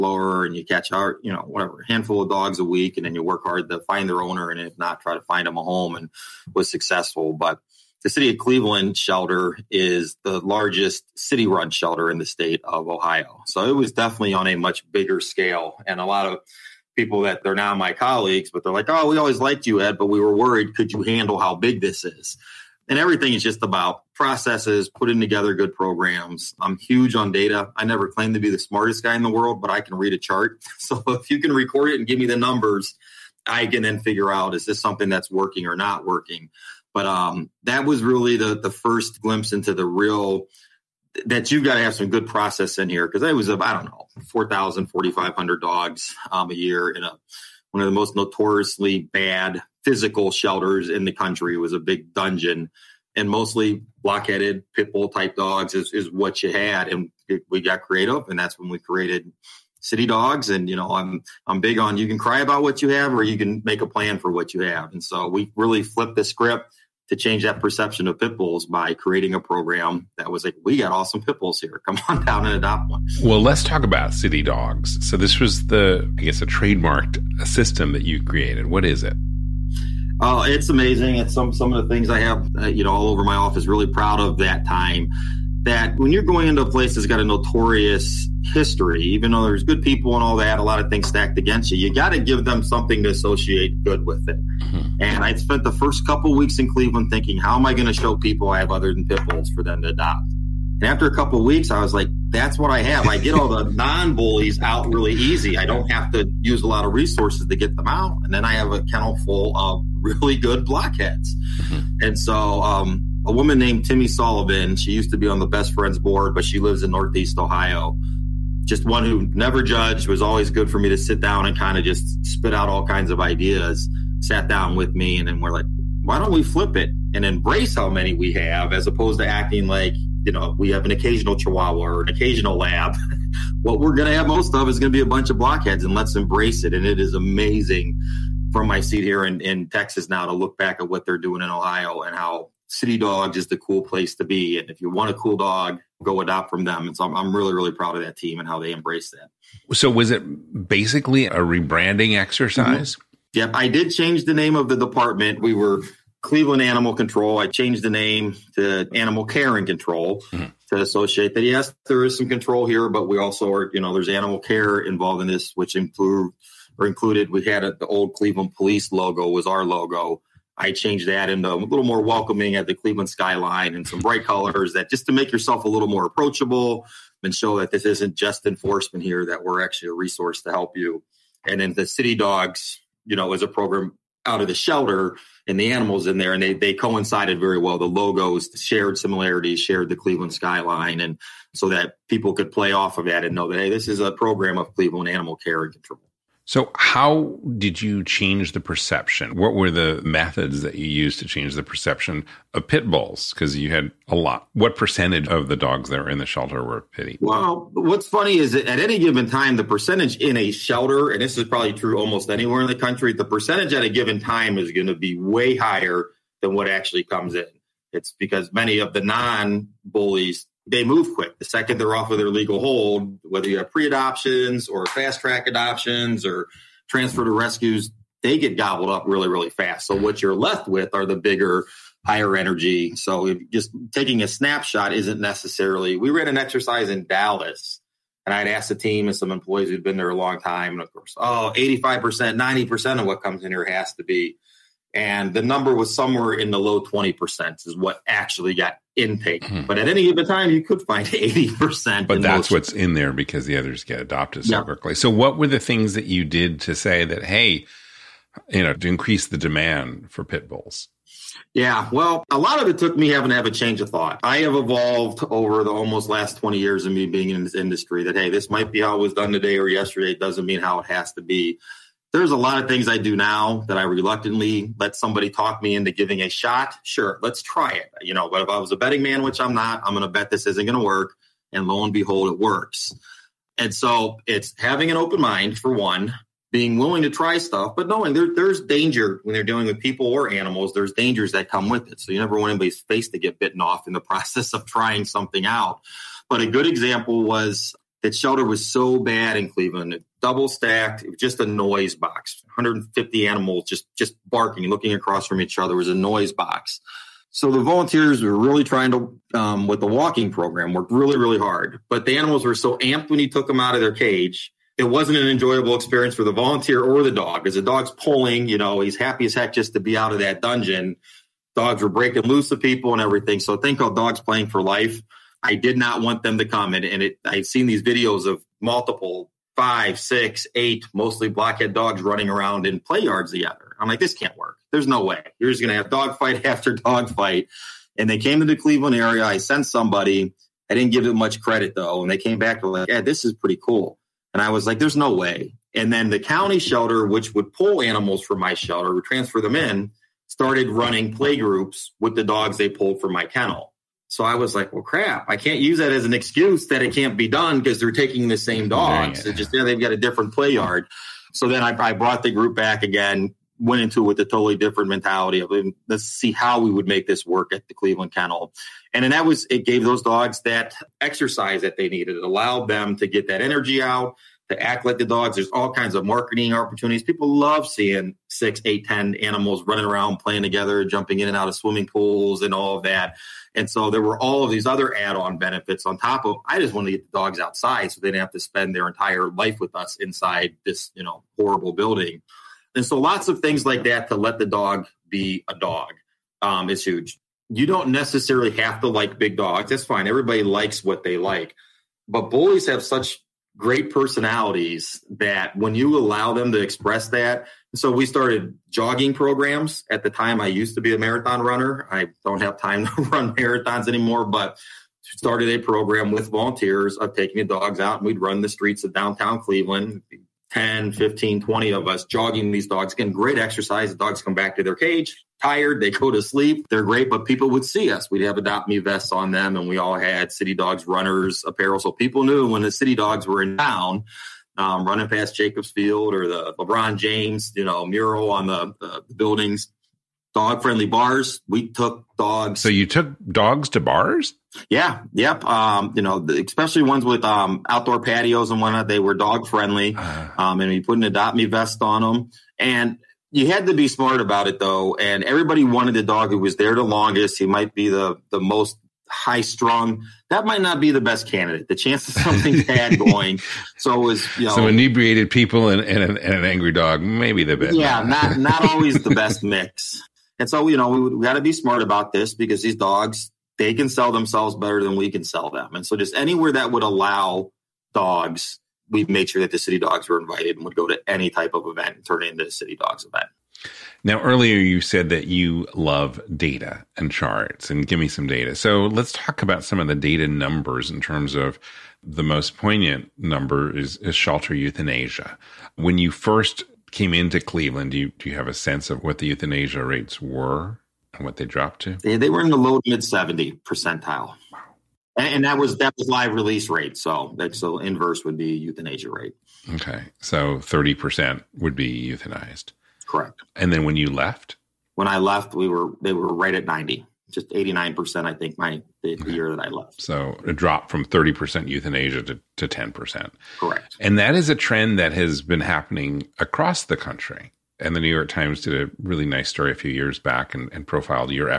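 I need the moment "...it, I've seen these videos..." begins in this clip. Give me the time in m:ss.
5:27.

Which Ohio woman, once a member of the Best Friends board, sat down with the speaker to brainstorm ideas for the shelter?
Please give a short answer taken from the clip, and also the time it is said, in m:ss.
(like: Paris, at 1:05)
Timmy Sullivan, at 1:53.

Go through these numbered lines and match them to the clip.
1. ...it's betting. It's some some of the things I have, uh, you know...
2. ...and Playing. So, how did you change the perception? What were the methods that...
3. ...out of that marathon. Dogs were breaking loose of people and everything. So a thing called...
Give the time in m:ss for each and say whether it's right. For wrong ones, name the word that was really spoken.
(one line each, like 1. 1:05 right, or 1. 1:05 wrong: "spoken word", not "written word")
1. 1:20 wrong: "amazing", not "betting"
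2. 3:15 wrong: "Control", not "Playing"
3. 5:19 wrong: "dungeon", not "marathon".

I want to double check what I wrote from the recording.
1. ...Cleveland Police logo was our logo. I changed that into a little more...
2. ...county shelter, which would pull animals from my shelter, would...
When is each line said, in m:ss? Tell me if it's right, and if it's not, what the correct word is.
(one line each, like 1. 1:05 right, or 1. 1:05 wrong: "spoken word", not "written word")
1. 2:48 right
2. 5:46 right.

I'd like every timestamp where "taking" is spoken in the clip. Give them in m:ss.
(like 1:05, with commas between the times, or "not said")
3:53, 5:57, 6:57.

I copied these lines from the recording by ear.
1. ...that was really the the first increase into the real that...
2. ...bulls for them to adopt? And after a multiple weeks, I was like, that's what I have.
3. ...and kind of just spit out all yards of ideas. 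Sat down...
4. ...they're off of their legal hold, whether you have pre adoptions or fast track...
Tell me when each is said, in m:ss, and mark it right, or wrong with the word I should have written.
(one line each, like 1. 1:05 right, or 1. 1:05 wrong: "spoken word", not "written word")
1. 0:37 wrong: "glimpse", not "increase"
2. 1:39 wrong: "couple", not "multiple"
3. 2:01 wrong: "kinds", not "yards"
4. 3:41 right.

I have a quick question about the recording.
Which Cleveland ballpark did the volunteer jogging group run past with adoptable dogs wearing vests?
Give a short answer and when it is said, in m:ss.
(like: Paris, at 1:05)
Jacobs Field, at 7:15.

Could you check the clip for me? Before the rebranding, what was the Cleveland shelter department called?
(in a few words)
Cleveland Animal Control.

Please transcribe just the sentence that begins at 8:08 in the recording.
So, let's talk about some of the data numbers in terms of the most poignant number is, is shelter euthanasia.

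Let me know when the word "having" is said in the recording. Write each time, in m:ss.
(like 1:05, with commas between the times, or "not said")
4:23, 4:44.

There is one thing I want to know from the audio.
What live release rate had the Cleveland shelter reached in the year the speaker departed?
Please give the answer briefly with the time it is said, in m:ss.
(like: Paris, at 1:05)
89%, at 8:37.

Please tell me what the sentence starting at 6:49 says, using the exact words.
At the time, I used to be a marathon runner.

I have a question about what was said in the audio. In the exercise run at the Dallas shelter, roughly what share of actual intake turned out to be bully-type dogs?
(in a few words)
low 20%.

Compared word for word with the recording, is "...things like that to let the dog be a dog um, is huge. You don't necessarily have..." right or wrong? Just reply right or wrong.
right.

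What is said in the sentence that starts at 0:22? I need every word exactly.
and everything is just about processes, putting together good programs.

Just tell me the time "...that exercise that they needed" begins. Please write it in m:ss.
6:10.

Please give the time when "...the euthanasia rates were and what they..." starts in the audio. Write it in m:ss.
8:19.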